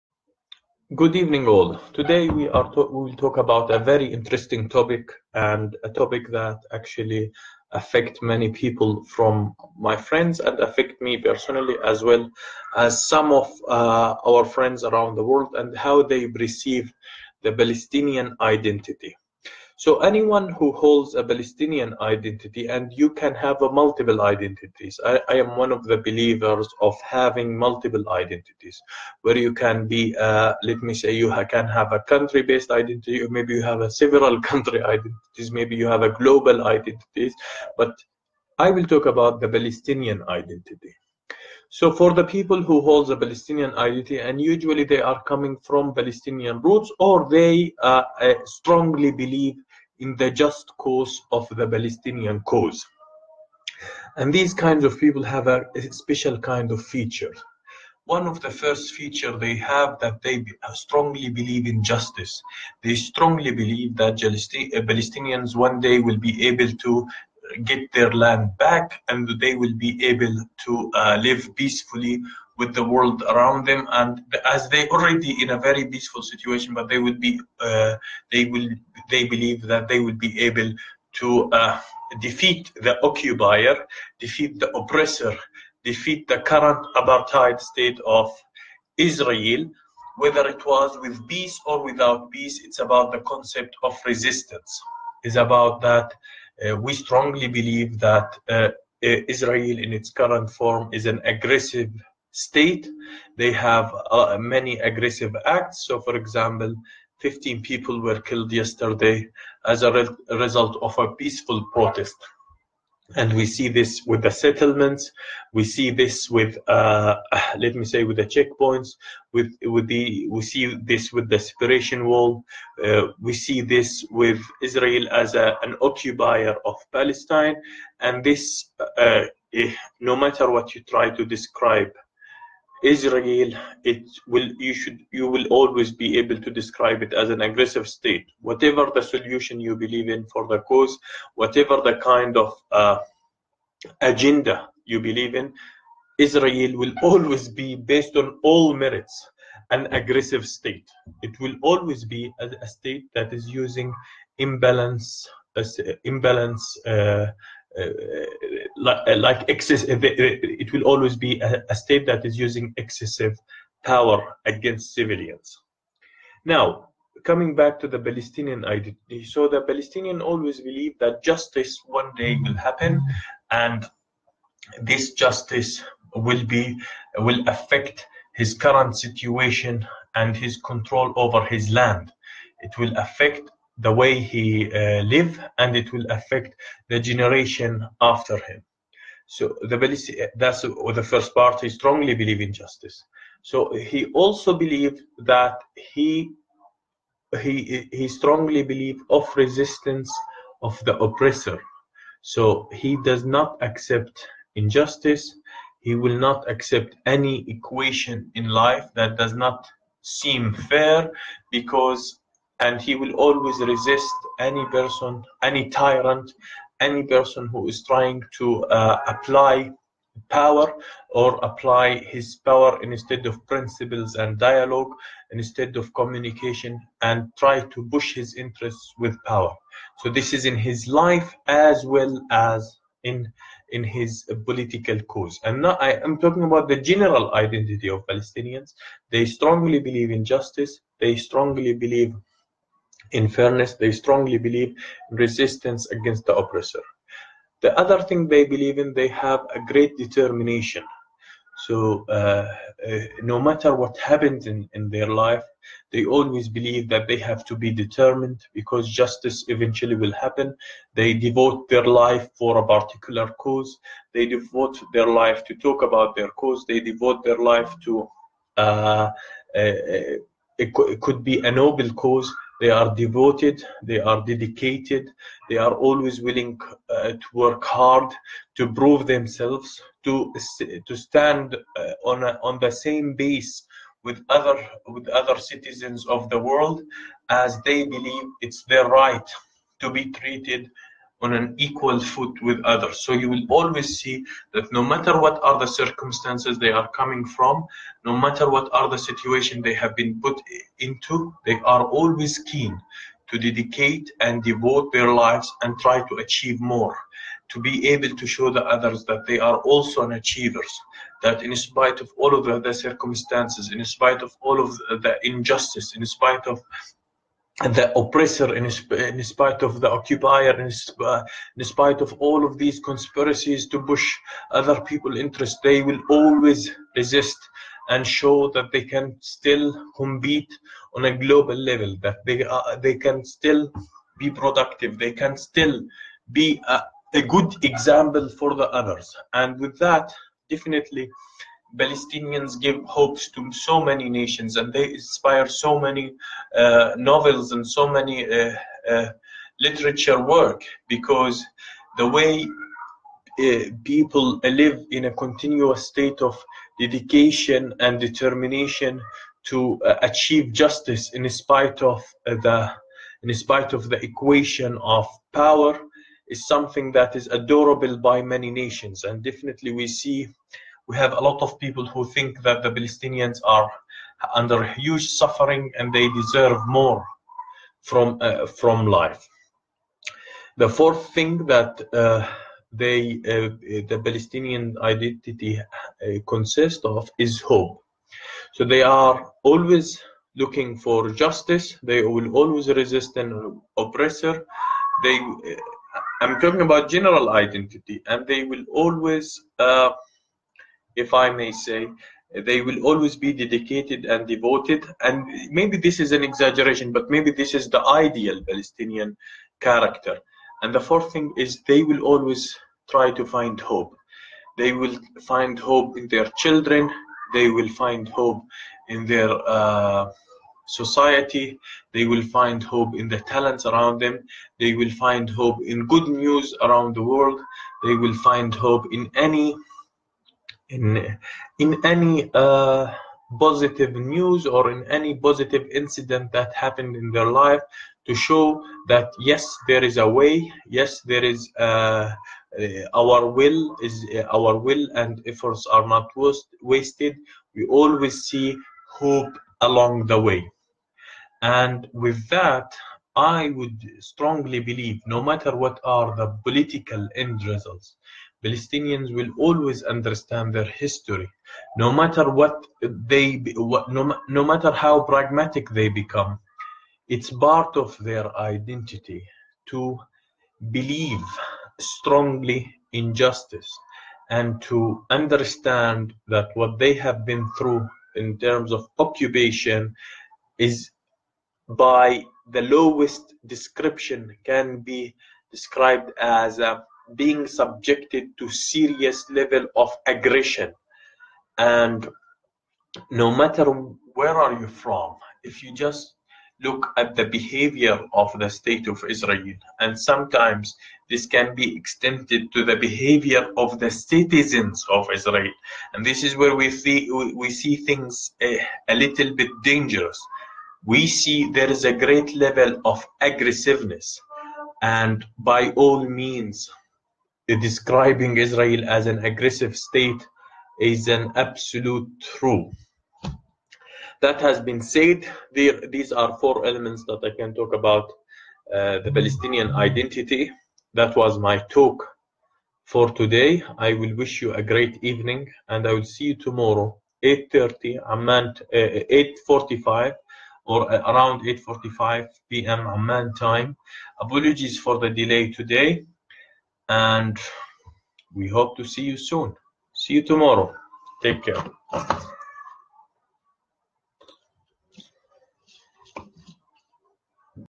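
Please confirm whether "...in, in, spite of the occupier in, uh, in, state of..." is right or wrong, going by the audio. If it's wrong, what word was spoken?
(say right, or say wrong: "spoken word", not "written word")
wrong: "spite", not "state".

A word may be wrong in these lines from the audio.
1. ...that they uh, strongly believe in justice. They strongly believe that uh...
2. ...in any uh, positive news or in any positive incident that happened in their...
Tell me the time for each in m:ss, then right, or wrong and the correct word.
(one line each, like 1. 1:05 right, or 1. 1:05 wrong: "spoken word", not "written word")
1. 0:59 right
2. 7:11 right.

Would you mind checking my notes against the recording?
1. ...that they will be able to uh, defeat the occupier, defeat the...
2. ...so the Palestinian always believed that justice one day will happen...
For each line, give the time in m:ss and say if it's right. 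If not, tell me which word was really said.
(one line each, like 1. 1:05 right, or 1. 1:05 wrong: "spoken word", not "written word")
1. 1:19 right
2. 2:49 right.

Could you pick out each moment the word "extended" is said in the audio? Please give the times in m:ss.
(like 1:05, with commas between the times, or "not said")
8:21.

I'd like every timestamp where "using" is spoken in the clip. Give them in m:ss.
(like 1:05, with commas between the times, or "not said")
2:33, 2:42.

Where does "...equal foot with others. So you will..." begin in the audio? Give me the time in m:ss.
4:51.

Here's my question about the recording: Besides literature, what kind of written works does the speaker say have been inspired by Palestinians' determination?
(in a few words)
novels.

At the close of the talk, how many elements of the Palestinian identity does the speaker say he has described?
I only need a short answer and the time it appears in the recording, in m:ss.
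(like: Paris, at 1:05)
4, at 8:46.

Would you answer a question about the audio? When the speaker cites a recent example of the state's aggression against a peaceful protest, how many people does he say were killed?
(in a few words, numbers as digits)
15.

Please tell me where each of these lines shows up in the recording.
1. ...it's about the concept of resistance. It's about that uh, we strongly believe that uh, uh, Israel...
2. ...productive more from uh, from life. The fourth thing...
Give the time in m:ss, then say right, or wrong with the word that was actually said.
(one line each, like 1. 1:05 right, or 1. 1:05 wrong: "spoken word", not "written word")
1. 1:32 right
2. 6:16 wrong: "deserve", not "productive".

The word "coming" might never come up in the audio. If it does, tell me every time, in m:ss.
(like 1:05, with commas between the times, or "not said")
0:45, 2:47, 4:56.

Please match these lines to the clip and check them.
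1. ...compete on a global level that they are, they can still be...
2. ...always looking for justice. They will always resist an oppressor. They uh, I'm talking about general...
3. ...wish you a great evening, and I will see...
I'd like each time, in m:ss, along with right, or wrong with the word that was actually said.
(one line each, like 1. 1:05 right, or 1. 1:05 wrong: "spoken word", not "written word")
1. 5:29 right
2. 6:29 right
3. 8:54 right.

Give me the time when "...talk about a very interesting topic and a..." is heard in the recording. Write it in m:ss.
0:03.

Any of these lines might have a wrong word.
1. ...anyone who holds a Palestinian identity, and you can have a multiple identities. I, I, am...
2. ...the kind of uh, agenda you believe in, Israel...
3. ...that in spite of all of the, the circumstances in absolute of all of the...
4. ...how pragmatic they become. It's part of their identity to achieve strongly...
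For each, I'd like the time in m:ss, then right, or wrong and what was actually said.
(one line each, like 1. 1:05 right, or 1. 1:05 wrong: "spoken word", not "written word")
1. 0:20 right
2. 2:21 right
3. 5:11 wrong: "spite", not "absolute"
4. 7:44 wrong: "believe", not "achieve".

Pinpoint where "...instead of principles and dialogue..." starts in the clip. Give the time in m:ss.
3:42.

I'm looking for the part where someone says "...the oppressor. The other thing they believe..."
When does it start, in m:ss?
4:06.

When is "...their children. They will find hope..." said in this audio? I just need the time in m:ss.
6:56.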